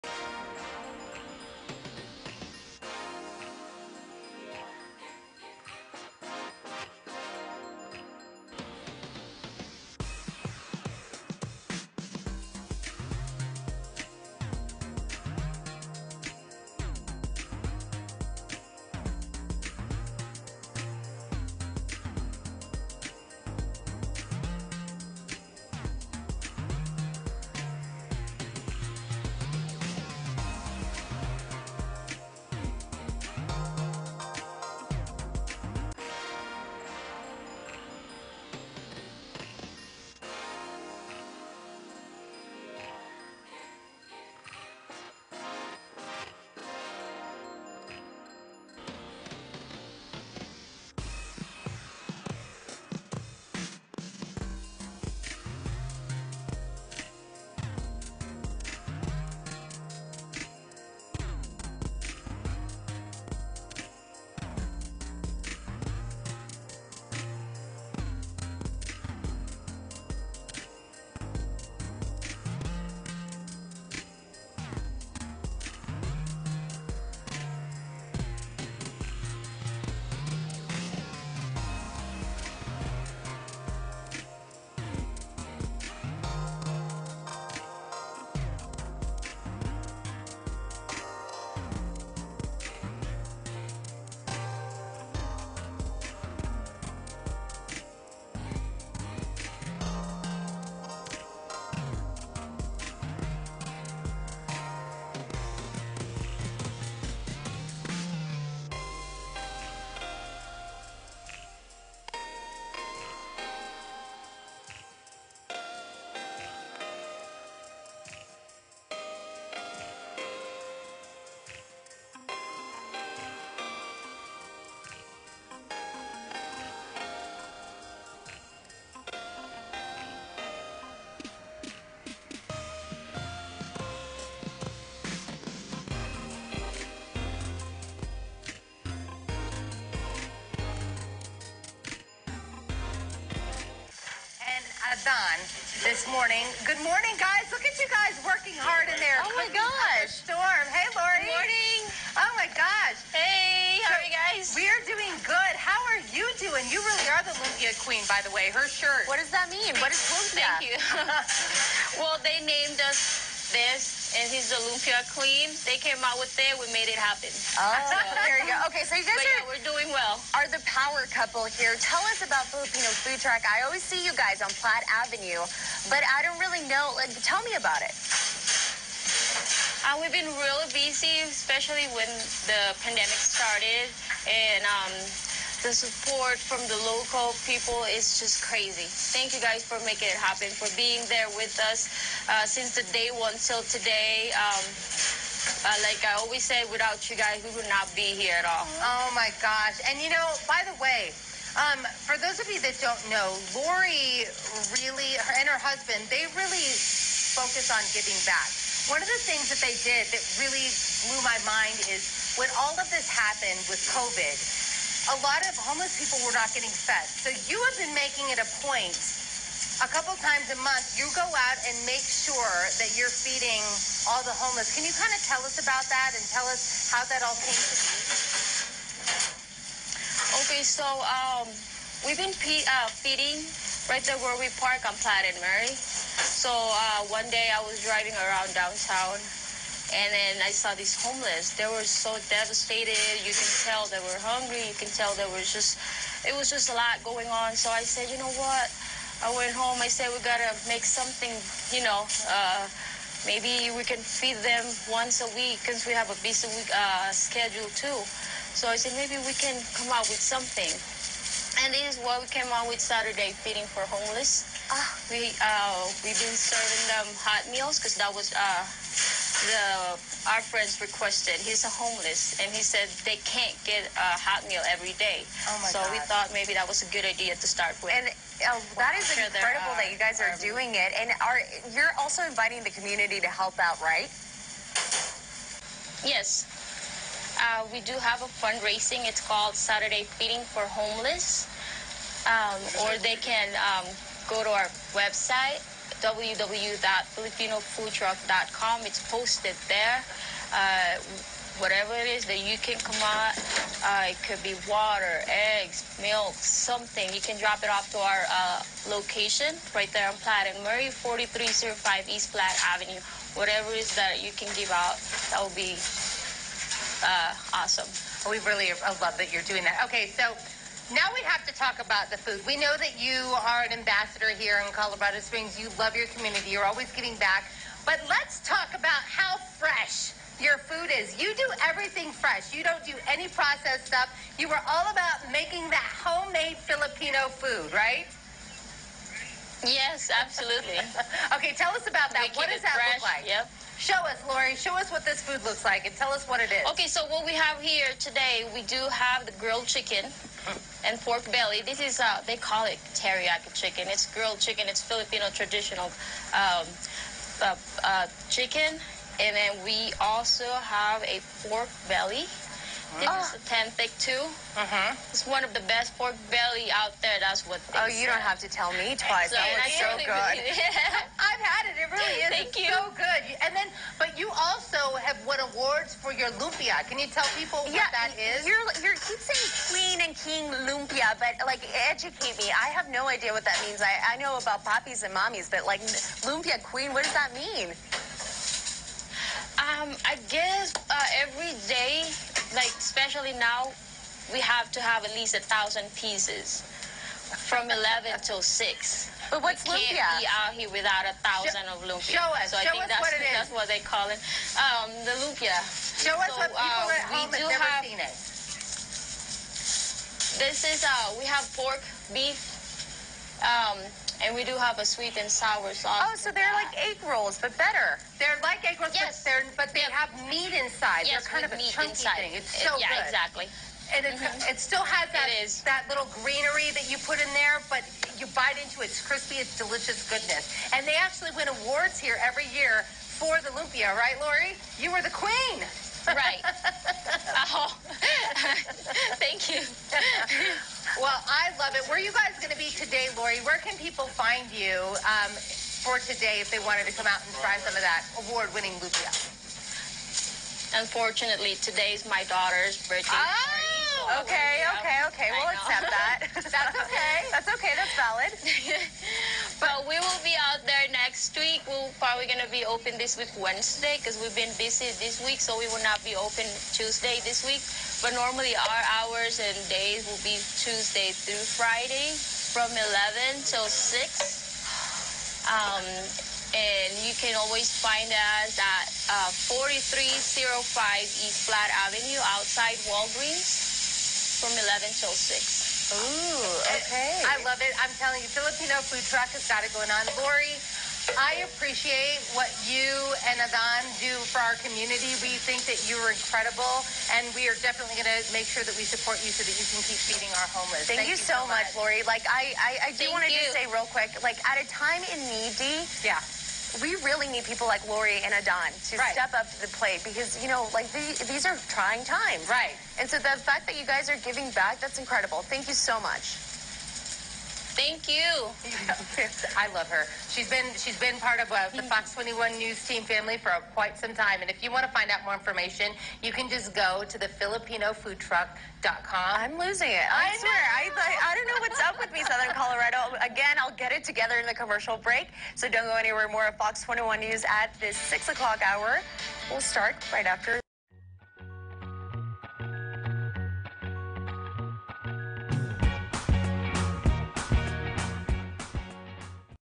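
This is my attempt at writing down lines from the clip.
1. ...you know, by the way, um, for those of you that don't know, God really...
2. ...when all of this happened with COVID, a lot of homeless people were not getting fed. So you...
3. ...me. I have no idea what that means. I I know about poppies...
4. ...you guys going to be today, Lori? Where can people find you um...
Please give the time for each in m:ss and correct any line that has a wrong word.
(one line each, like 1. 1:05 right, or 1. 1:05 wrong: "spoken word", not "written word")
1. 3:20 wrong: "Lori", not "God"
2. 3:32 right
3. 6:22 right
4. 7:22 right.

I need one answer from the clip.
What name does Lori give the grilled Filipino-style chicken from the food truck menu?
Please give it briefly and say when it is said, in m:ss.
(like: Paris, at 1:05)
Teriyaki chicken, at 5:52.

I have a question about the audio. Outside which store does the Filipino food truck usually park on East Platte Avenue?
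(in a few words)
Walgreens.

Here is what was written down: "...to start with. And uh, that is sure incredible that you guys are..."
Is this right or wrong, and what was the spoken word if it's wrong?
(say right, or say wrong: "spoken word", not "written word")
right.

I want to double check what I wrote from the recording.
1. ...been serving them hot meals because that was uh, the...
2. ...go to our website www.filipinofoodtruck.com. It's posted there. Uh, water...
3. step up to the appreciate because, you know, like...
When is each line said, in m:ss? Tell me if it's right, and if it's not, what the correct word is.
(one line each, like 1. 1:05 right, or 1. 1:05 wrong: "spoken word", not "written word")
1. 4:26 right
2. 4:54 wrong: "whatever", not "water"
3. 8:29 wrong: "plate", not "appreciate".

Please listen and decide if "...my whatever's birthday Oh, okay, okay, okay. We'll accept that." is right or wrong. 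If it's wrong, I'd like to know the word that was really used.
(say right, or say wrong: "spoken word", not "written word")
wrong: "daughter", not "whatever".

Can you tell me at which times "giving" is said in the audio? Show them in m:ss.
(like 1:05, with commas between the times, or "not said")
3:27, 5:26, 8:34.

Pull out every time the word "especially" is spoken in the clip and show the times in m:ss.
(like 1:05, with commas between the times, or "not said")
3:01, 6:32.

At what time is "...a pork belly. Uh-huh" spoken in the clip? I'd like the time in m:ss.
6:01.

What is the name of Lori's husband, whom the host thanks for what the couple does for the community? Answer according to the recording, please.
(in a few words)
Adan.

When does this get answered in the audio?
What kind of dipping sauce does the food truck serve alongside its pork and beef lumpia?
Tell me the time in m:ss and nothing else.
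6:54.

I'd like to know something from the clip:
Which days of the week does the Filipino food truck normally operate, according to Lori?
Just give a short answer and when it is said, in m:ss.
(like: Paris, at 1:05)
Tuesday through Friday, at 7:50.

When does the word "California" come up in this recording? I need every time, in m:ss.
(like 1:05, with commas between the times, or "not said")
8:52.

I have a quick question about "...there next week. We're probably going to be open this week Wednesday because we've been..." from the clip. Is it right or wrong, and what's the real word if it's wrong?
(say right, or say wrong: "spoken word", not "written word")
right.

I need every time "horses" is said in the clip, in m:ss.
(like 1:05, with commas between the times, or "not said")
not said.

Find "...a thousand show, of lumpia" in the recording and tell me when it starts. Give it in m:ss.
6:41.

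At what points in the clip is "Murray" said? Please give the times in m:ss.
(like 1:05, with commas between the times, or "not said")
3:55, 5:10.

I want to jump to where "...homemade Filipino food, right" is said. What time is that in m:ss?
5:36.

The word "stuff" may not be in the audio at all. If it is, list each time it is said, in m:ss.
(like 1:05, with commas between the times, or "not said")
5:33.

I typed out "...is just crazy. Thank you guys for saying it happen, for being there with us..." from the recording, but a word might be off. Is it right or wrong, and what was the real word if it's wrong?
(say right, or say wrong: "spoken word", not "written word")
wrong: "making", not "saying".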